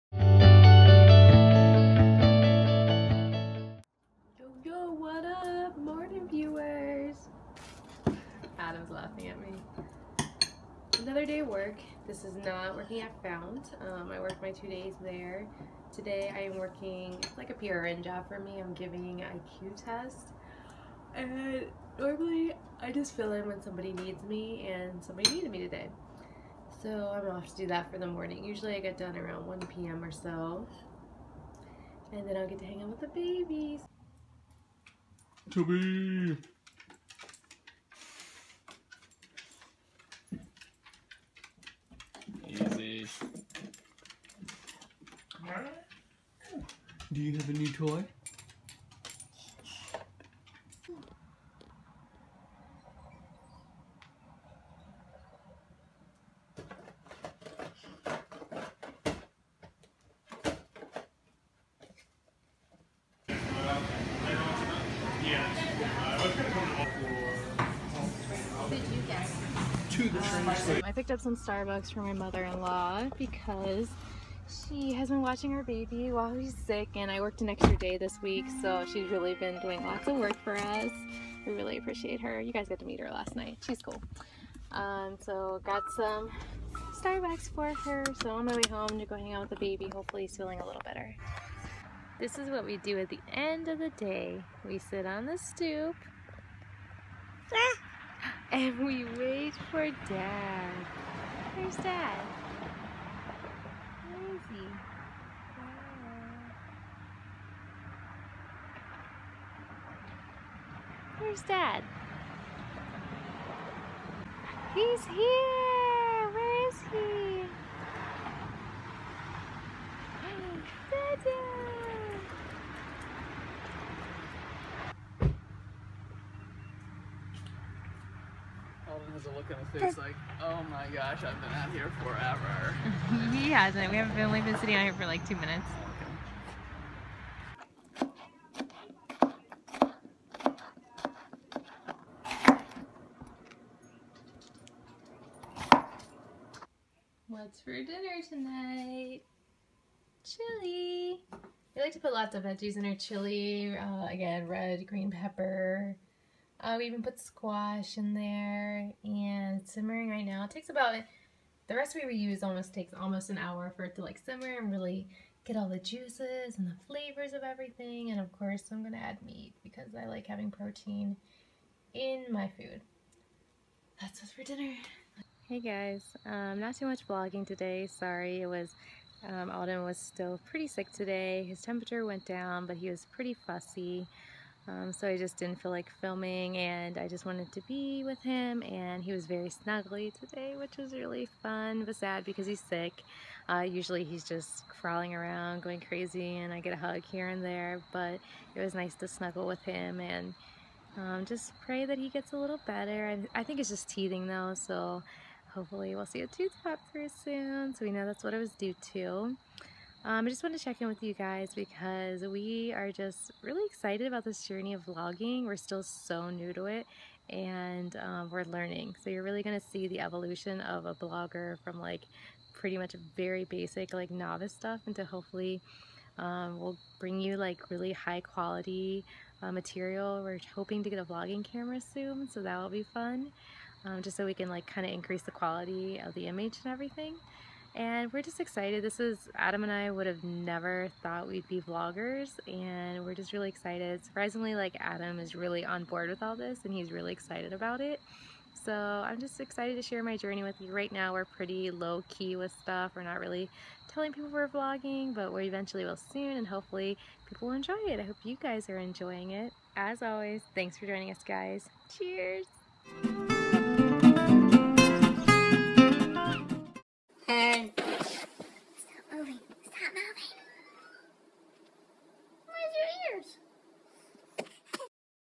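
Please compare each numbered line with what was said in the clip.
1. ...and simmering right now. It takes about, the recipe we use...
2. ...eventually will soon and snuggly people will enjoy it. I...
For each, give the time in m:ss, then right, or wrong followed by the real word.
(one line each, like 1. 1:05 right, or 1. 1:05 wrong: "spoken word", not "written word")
1. 2:39 right
2. 4:15 wrong: "hopefully", not "snuggly".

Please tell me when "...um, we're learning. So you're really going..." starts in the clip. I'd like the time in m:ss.
3:37.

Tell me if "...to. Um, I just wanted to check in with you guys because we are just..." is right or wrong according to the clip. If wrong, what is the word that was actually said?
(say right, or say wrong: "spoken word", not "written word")
right.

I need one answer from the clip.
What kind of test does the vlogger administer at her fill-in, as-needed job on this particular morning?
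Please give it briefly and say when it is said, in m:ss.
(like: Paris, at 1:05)
IQ test, at 0:19.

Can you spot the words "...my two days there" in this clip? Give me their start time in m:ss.
0:14.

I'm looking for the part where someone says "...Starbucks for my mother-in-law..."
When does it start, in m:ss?
1:11.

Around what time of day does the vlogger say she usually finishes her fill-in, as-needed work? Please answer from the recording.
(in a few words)
1 p.m.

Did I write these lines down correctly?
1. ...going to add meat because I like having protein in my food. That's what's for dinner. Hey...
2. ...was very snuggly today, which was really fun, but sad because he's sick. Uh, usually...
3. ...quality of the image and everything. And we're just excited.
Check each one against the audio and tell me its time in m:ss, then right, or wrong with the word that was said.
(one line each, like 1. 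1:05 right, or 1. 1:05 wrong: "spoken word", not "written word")
1. 2:48 right
2. 3:09 right
3. 3:55 right.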